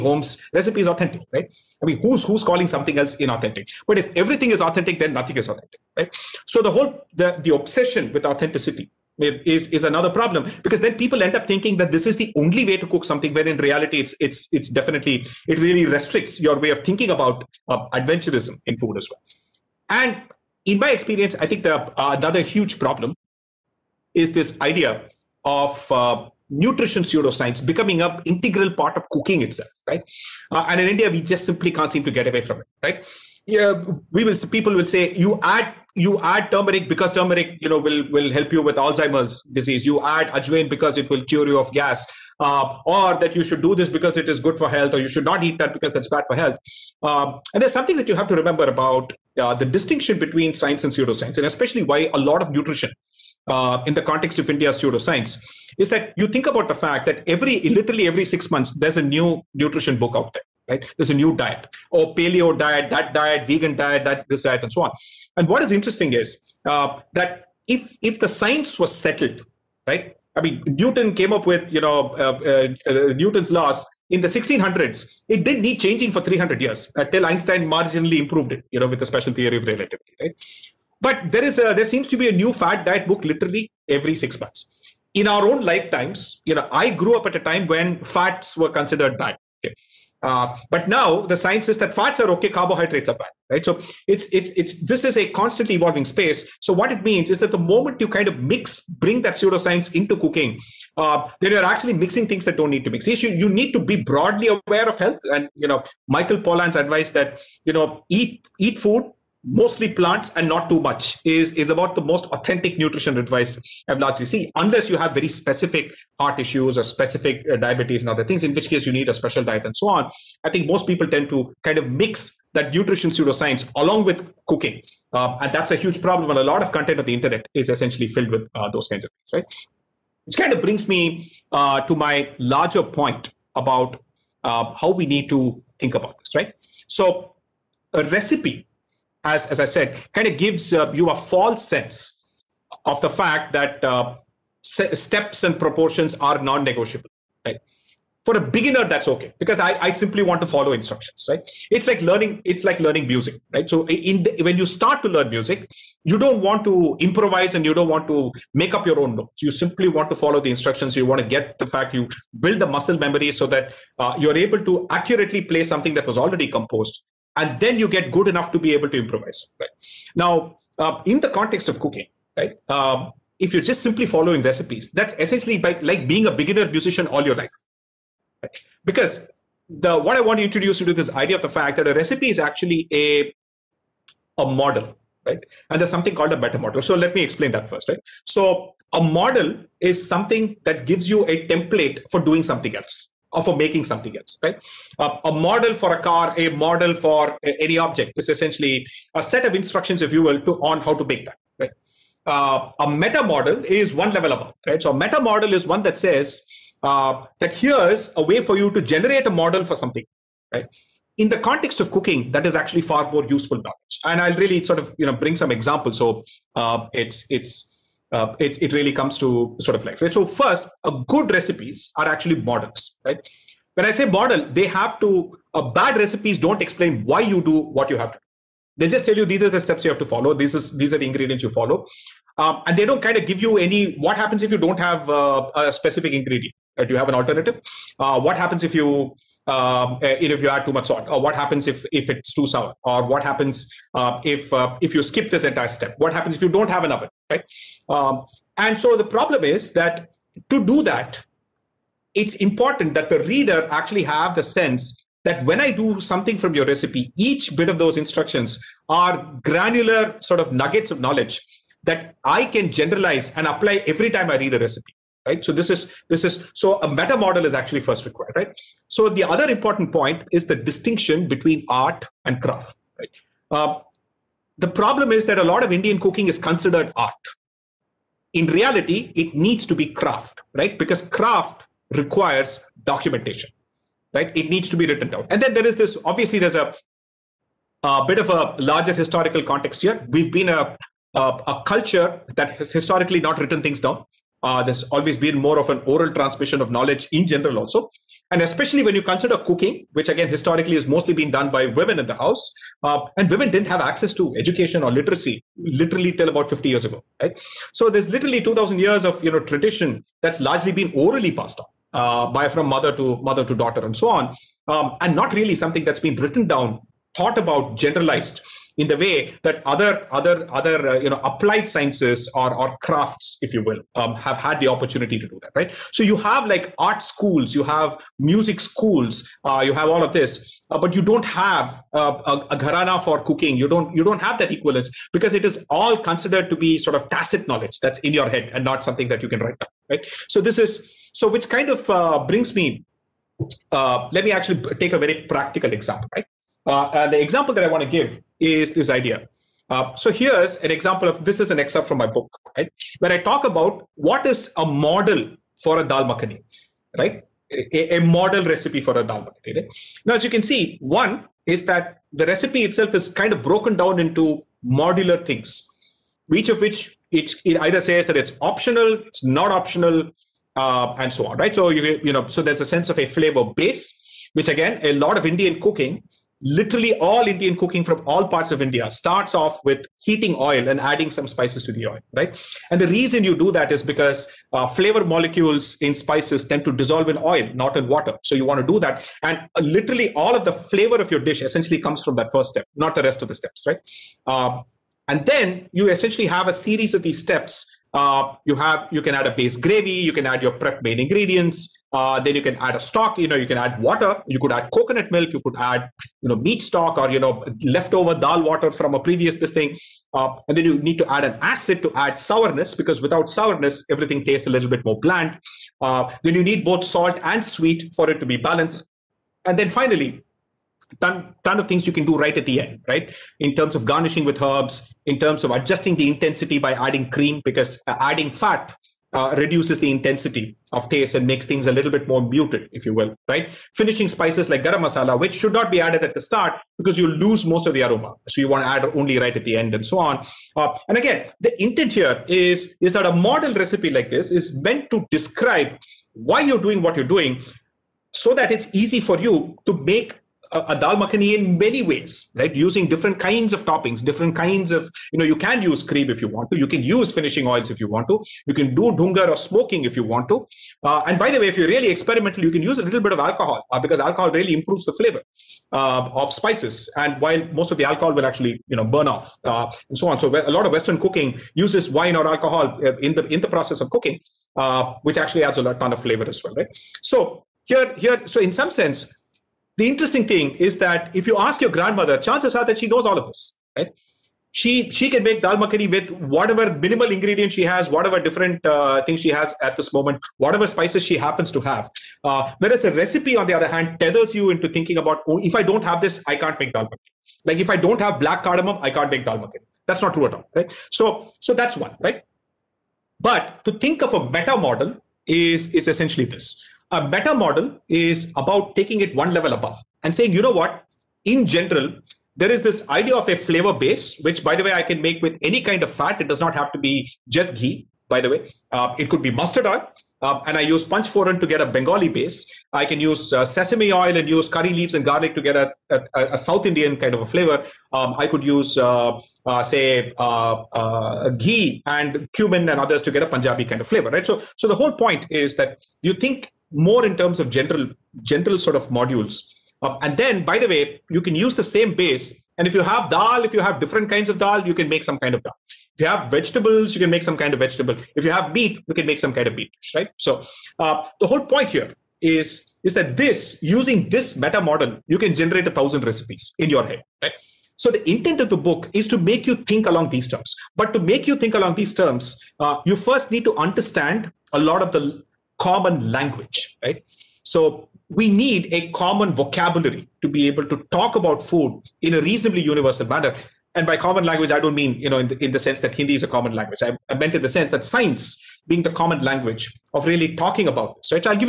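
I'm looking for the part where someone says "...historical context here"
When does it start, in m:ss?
4:48.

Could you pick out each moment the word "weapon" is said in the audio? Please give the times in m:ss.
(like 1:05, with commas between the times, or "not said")
not said.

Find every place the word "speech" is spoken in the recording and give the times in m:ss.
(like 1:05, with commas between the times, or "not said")
not said.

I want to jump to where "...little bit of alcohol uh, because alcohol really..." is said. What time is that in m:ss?
7:42.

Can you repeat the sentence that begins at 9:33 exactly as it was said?
And by common language, I don't mean, you know, in the, in the sense that Hindi is a common language.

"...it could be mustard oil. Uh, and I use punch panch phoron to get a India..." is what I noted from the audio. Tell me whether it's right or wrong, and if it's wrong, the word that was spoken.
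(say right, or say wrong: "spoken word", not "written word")
wrong: "Bengali", not "India".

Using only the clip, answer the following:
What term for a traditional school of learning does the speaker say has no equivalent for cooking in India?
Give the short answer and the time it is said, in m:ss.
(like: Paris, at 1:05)
gharana, at 5:32.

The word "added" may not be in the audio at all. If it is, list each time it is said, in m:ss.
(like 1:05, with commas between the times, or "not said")
7:15.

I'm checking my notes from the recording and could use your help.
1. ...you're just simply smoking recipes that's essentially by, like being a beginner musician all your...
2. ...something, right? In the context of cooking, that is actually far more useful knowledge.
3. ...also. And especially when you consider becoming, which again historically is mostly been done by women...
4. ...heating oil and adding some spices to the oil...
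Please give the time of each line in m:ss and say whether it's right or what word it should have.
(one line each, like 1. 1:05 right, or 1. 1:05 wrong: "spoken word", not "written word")
1. 2:53 wrong: "following", not "smoking"
2. 3:29 right
3. 4:57 wrong: "cooking", not "becoming"
4. 6:20 right.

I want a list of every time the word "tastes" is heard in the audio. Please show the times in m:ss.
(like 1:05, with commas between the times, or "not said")
6:54, 7:10.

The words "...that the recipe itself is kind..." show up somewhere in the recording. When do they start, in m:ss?
6:01.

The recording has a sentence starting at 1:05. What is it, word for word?
And what is interesting is uh, that if if the science was settled, right?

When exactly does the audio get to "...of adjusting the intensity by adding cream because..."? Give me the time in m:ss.
7:05.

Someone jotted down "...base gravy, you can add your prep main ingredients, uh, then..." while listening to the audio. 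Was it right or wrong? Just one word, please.
right.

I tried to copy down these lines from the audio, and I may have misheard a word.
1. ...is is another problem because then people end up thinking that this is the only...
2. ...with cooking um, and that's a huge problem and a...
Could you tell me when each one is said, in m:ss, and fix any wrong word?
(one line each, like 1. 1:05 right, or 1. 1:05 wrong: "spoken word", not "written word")
1. 0:09 right
2. 2:04 right.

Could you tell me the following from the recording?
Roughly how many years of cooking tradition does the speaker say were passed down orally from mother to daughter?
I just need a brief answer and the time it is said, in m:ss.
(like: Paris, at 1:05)
2,000, at 5:08.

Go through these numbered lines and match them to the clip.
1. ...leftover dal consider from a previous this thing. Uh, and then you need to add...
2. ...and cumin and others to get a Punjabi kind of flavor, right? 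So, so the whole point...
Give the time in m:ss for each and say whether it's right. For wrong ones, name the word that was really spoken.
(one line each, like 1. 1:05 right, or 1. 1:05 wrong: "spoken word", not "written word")
1. 6:47 wrong: "water", not "consider"
2. 8:51 right.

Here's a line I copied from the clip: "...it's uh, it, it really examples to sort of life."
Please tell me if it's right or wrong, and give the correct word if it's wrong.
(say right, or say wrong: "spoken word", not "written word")
wrong: "comes", not "examples".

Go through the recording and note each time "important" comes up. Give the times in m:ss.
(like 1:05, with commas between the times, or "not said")
4:12, 4:29.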